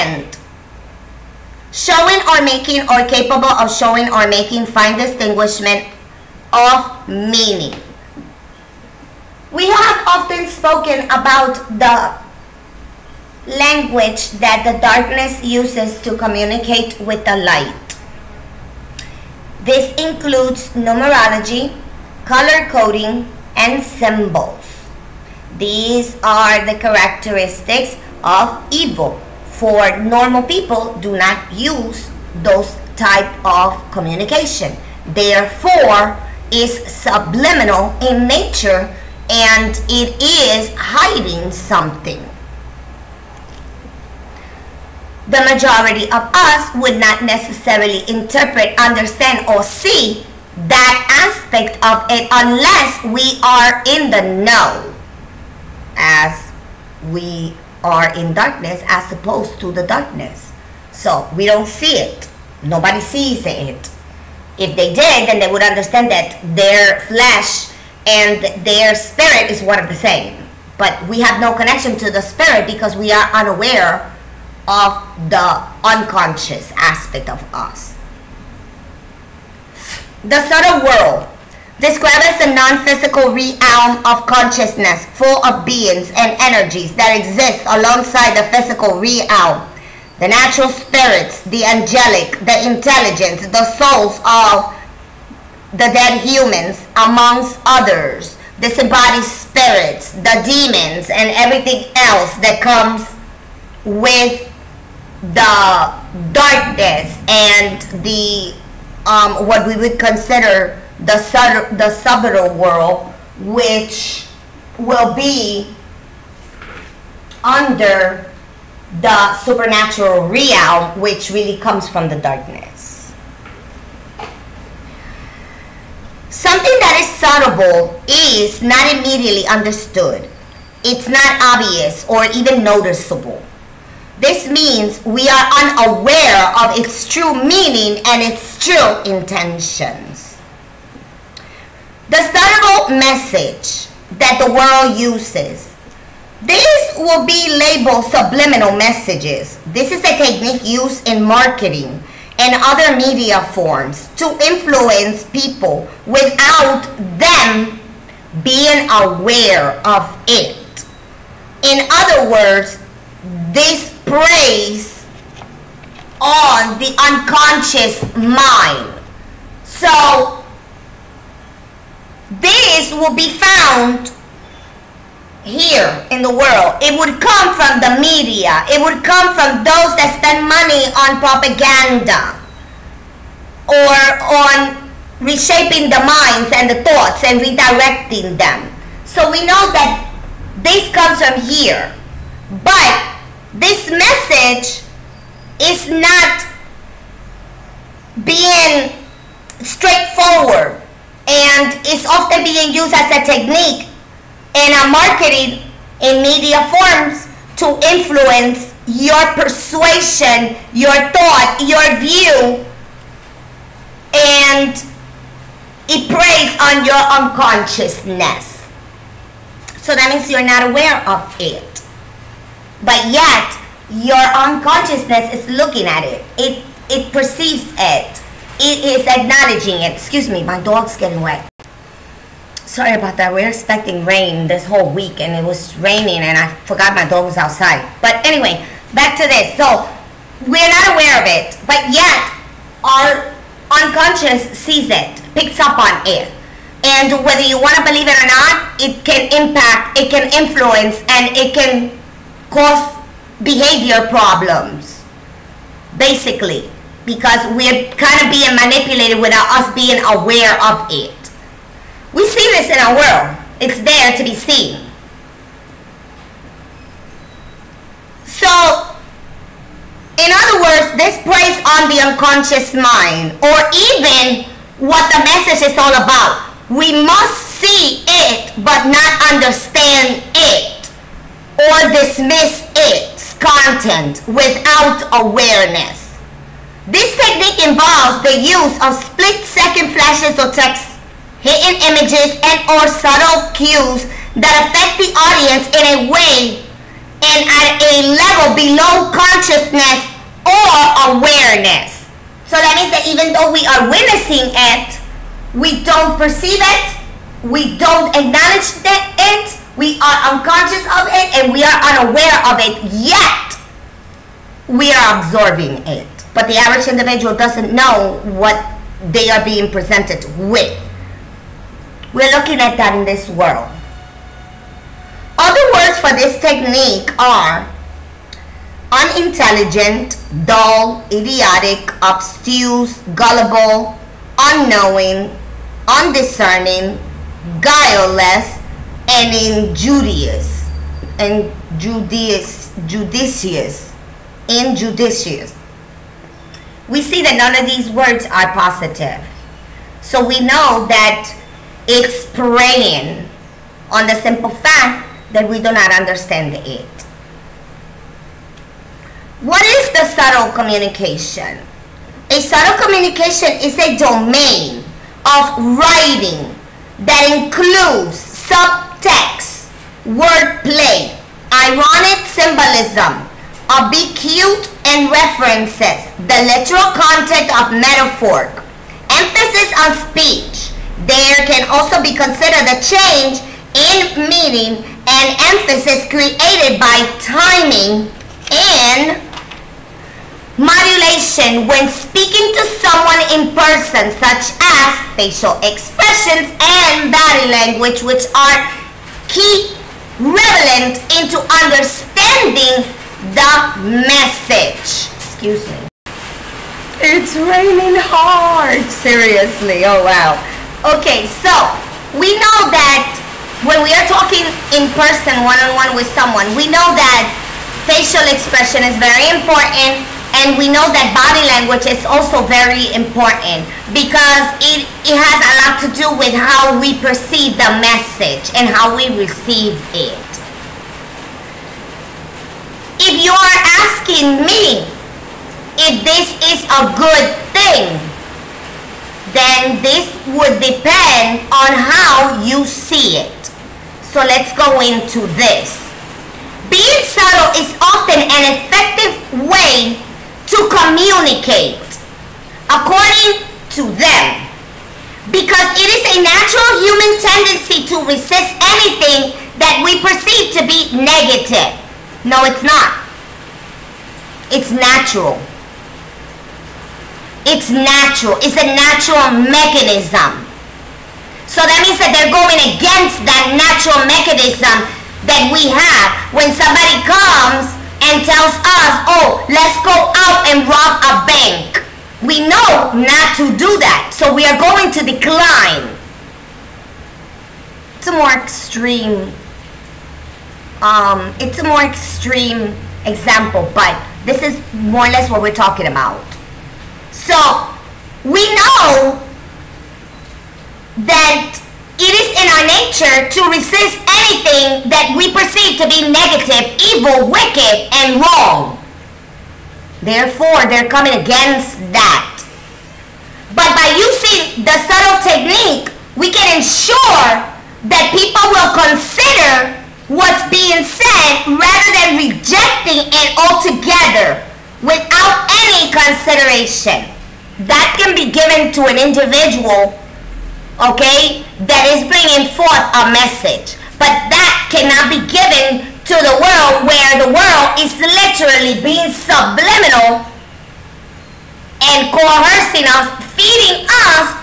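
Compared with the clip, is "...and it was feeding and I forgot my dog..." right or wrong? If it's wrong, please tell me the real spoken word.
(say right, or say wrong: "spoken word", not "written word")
wrong: "raining", not "feeding".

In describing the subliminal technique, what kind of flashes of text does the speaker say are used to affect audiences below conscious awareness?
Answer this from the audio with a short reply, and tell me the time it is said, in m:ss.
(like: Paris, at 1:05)
split-second flashes, at 4:48.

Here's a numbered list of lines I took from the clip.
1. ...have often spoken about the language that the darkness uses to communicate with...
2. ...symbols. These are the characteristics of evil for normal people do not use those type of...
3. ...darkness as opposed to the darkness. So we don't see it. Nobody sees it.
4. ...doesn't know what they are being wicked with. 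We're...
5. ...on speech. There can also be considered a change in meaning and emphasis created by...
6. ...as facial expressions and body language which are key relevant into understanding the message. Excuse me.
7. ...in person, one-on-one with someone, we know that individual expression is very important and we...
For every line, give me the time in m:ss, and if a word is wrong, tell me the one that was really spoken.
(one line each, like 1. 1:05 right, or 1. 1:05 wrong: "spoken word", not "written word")
1. 0:09 right
2. 0:23 right
3. 0:58 right
4. 5:17 wrong: "presented", not "wicked"
5. 6:19 right
6. 6:34 right
7. 6:54 wrong: "facial", not "individual".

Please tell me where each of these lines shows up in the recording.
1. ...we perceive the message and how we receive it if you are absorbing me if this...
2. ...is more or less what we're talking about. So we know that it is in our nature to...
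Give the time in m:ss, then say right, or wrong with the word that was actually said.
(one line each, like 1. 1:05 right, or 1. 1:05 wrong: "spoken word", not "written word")
1. 7:06 wrong: "asking", not "absorbing"
2. 8:14 right.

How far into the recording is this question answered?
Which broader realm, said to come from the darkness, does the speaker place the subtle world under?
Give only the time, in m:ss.
1:59.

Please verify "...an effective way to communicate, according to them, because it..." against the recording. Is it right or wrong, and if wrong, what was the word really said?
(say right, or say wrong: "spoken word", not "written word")
right.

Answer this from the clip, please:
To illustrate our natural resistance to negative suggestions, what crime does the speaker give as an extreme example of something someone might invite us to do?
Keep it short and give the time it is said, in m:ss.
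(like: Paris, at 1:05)
rob a bank, at 8:00.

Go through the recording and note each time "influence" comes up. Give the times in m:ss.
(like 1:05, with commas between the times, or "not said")
2:34, 3:27, 4:10.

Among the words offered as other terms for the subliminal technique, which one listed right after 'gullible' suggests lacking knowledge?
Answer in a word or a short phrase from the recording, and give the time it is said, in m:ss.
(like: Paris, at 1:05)
unknowing, at 5:34.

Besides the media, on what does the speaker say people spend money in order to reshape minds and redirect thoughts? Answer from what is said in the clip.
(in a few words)
propaganda.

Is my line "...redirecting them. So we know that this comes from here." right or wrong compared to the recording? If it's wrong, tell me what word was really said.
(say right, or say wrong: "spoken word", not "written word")
right.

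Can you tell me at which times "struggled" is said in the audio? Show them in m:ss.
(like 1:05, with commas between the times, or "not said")
not said.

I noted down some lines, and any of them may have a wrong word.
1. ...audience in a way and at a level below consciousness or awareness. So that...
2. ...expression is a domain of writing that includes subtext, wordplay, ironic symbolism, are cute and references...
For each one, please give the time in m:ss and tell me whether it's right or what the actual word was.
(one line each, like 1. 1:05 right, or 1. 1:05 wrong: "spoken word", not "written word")
1. 4:55 right
2. 6:02 wrong: "communication", not "expression".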